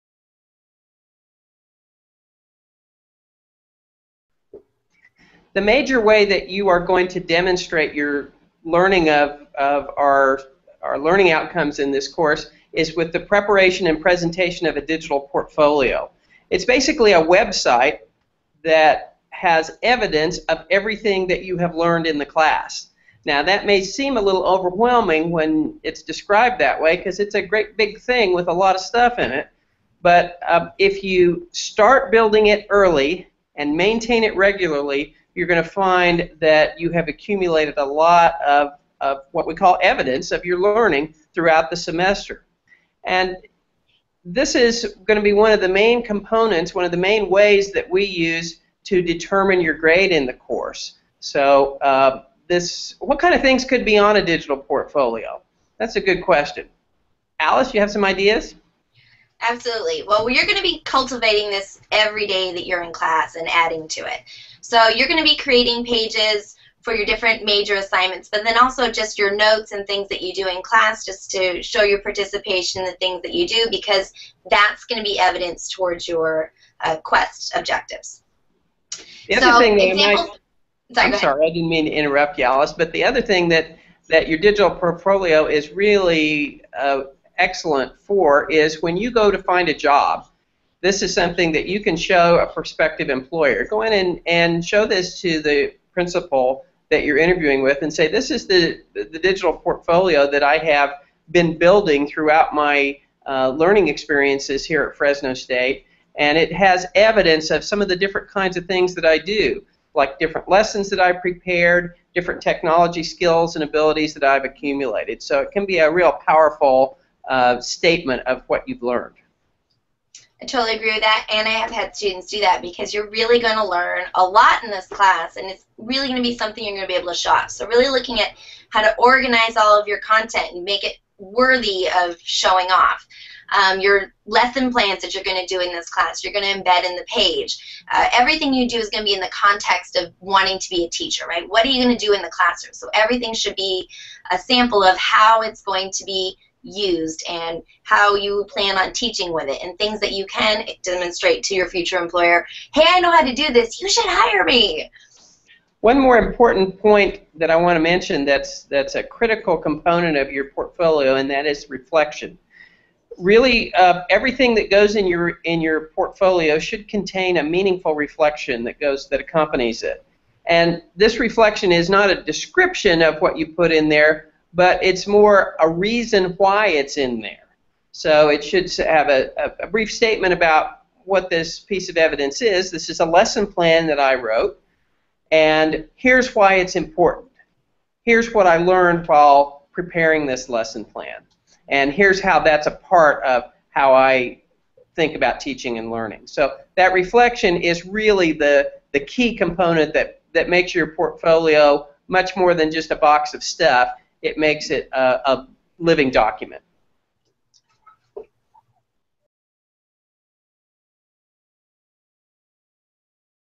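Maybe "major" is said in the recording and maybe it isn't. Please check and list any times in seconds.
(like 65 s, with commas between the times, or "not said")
5 s, 67 s.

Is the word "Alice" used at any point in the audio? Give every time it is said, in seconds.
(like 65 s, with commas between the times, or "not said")
57 s, 82 s.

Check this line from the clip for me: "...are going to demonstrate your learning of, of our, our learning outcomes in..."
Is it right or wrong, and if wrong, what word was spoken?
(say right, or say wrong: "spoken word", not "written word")
right.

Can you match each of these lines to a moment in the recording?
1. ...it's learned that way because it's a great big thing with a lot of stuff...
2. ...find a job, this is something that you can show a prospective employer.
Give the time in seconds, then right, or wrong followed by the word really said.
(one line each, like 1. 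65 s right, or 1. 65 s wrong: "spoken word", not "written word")
1. 25 s wrong: "described", not "learned"
2. 89 s right.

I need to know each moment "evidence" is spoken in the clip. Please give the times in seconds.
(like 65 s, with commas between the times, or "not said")
19 s, 39 s, 75 s, 106 s, 181 s.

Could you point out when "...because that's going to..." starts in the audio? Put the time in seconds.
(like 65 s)
73 s.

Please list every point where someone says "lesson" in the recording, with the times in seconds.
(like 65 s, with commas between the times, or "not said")
110 s, 134 s, 183 s, 190 s.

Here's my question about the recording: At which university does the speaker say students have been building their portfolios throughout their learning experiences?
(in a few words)
Fresno State.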